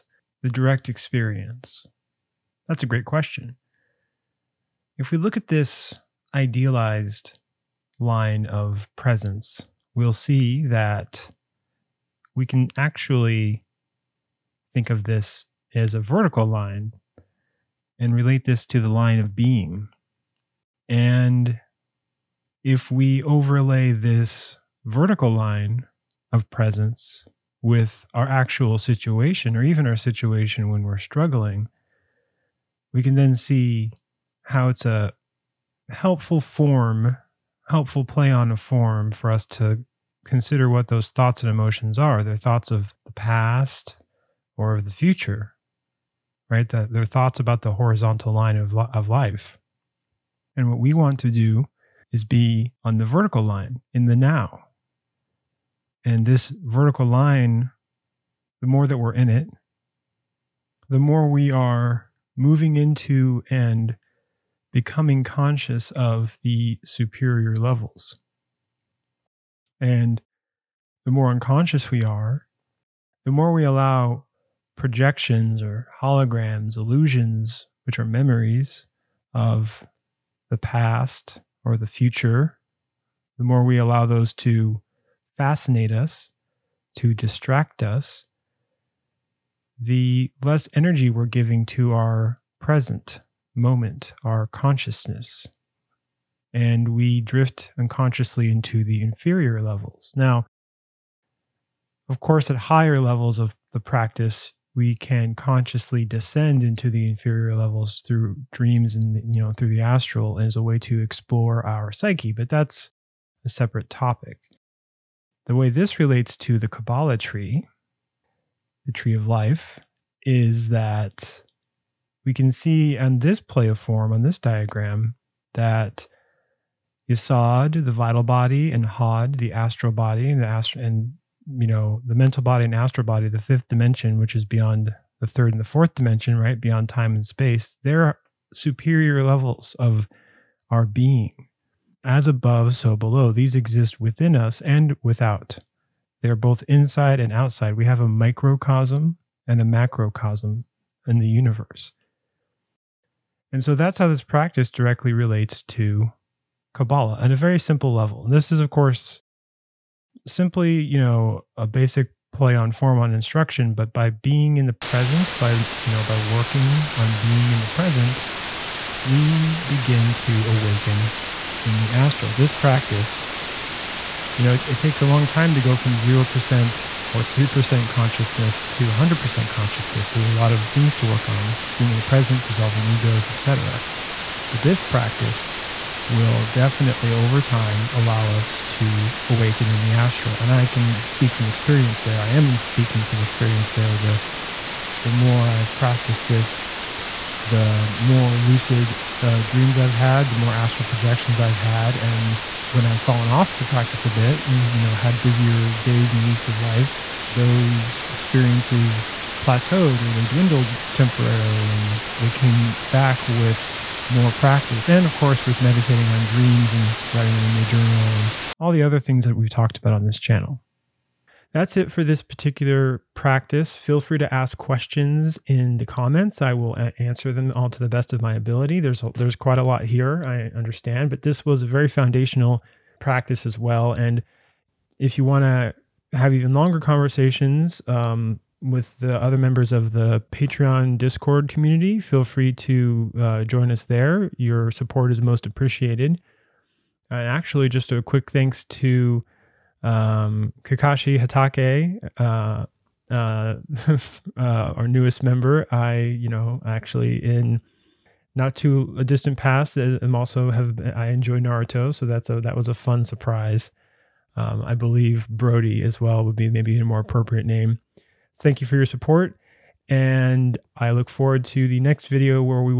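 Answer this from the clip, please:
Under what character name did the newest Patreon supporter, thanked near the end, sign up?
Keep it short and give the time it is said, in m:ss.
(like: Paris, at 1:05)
Kakashi Hatake, at 4:10.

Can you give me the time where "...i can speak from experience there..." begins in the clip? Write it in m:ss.
3:10.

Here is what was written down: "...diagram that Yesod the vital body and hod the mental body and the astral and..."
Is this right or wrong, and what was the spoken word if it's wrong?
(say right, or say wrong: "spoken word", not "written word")
wrong: "astral", not "mental".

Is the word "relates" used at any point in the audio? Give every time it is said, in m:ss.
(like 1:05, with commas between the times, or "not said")
0:18, 1:55, 2:35.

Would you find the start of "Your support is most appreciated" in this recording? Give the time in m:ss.
4:04.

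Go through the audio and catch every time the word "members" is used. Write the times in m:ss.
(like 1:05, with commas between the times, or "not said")
3:59, 4:15.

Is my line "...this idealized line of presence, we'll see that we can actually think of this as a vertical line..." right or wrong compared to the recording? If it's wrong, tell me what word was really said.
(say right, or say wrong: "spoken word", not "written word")
right.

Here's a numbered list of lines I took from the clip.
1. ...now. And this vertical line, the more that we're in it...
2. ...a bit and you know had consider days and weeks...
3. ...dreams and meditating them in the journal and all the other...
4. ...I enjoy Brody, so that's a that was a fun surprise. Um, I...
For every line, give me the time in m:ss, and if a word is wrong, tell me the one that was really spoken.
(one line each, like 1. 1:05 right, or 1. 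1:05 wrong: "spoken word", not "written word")
1. 0:54 right
2. 3:24 wrong: "busier", not "consider"
3. 3:36 wrong: "writing", not "meditating"
4. 4:20 wrong: "Naruto", not "Brody".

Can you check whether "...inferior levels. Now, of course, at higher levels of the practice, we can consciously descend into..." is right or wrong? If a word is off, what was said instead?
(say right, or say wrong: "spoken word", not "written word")
right.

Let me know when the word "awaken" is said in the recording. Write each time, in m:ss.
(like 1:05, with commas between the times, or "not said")
2:50, 3:09.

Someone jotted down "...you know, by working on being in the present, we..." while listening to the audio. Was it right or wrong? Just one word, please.
right.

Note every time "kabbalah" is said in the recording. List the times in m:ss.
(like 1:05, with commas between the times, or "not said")
1:56, 2:36.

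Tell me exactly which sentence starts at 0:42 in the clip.
They're thoughts of the past or of the future, right?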